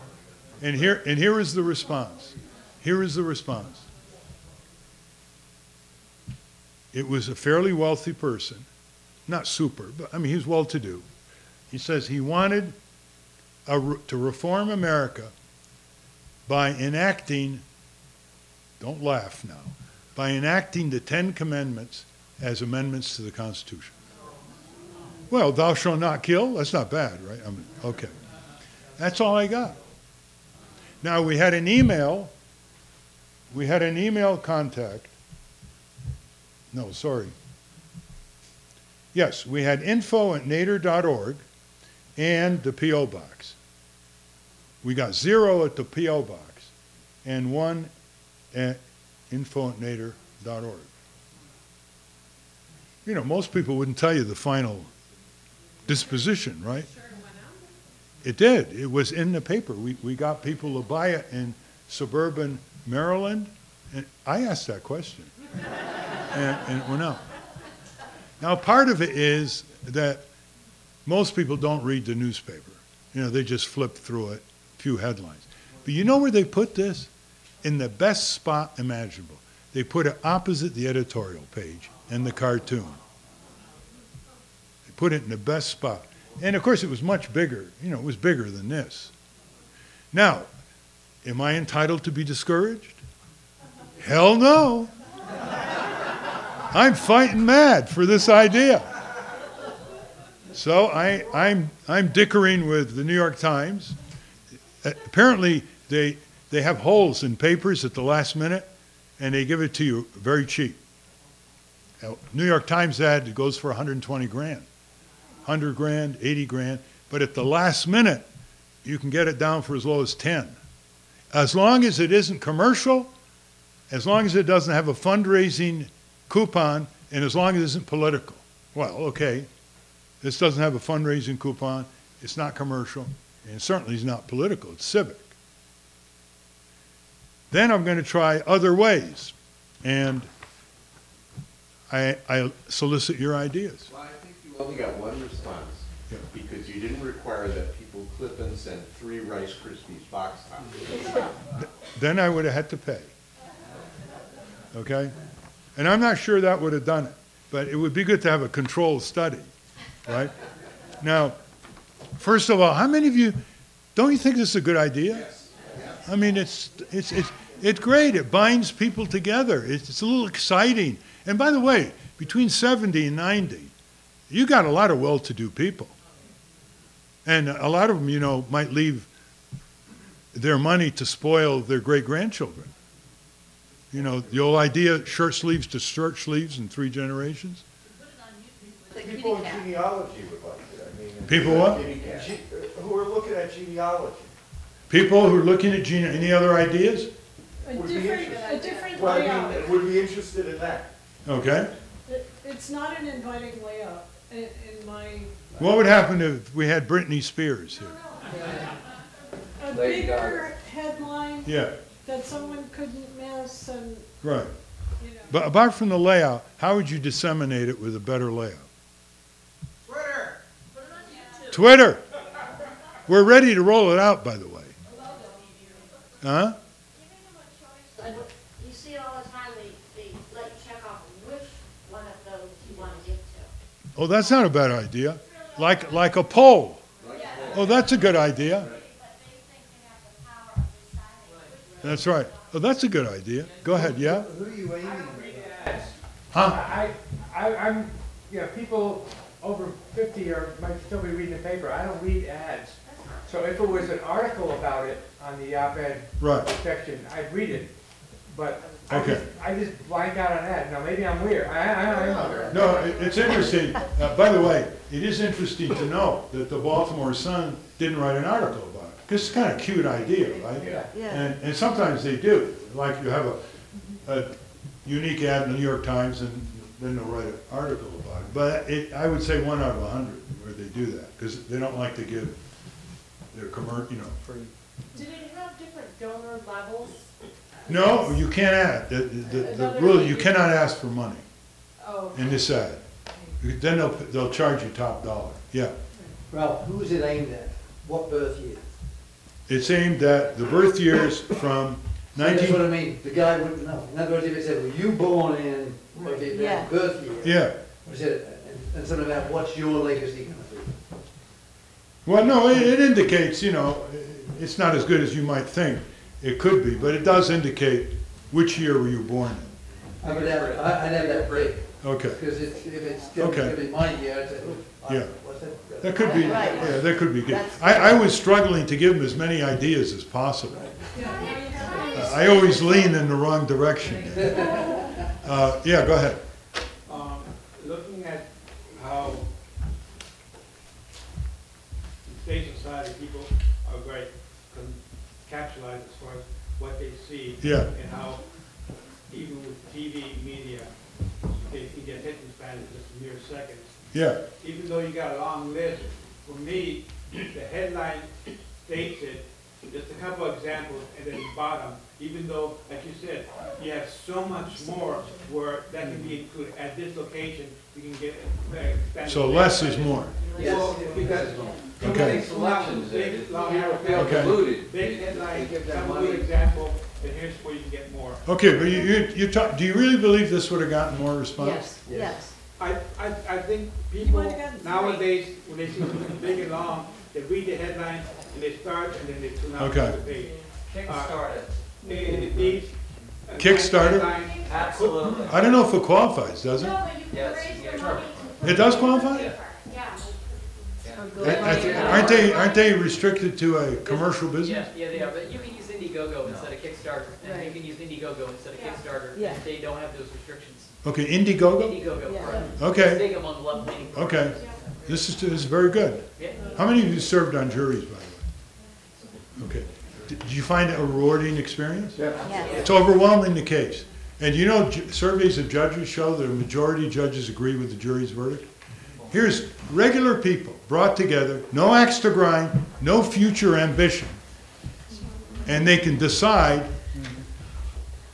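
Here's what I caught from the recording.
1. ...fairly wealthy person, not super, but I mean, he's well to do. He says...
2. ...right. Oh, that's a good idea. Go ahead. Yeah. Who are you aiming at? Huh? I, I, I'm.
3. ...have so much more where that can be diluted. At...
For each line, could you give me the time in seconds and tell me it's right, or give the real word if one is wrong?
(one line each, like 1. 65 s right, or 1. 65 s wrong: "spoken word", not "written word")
1. 7 s right
2. 242 s right
3. 363 s wrong: "included", not "diluted".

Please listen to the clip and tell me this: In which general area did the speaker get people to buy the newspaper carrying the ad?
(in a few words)
suburban Maryland.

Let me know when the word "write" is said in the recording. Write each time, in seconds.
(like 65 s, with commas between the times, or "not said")
267 s, 277 s.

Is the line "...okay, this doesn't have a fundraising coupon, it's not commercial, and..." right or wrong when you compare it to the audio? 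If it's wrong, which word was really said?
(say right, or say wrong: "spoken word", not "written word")
right.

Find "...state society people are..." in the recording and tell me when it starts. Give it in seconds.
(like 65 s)
342 s.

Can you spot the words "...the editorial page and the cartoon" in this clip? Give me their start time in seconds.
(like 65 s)
80 s.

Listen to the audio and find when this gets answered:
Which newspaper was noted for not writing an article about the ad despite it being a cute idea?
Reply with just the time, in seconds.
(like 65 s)
266 s.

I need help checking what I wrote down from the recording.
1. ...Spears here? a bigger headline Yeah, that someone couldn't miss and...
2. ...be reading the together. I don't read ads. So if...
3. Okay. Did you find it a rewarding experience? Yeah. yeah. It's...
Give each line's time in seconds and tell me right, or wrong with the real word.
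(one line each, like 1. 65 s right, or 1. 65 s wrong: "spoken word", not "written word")
1. 207 s right
2. 251 s wrong: "paper", not "together"
3. 419 s right.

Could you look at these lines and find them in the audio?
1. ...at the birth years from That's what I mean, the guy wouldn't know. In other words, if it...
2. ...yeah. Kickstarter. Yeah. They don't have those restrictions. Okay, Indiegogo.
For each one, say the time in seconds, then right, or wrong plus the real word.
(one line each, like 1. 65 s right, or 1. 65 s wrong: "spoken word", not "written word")
1. 300 s right
2. 408 s right.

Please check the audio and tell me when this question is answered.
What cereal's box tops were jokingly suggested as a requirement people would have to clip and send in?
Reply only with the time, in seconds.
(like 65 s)
149 s.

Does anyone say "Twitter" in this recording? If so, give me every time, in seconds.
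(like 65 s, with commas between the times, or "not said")
221 s.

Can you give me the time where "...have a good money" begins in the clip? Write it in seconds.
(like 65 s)
375 s.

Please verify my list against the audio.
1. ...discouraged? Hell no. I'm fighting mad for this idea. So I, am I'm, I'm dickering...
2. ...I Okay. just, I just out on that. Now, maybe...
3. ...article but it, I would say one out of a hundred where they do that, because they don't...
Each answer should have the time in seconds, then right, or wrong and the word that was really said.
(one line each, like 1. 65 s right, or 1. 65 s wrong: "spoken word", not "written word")
1. 92 s right
2. 258 s right
3. 277 s right.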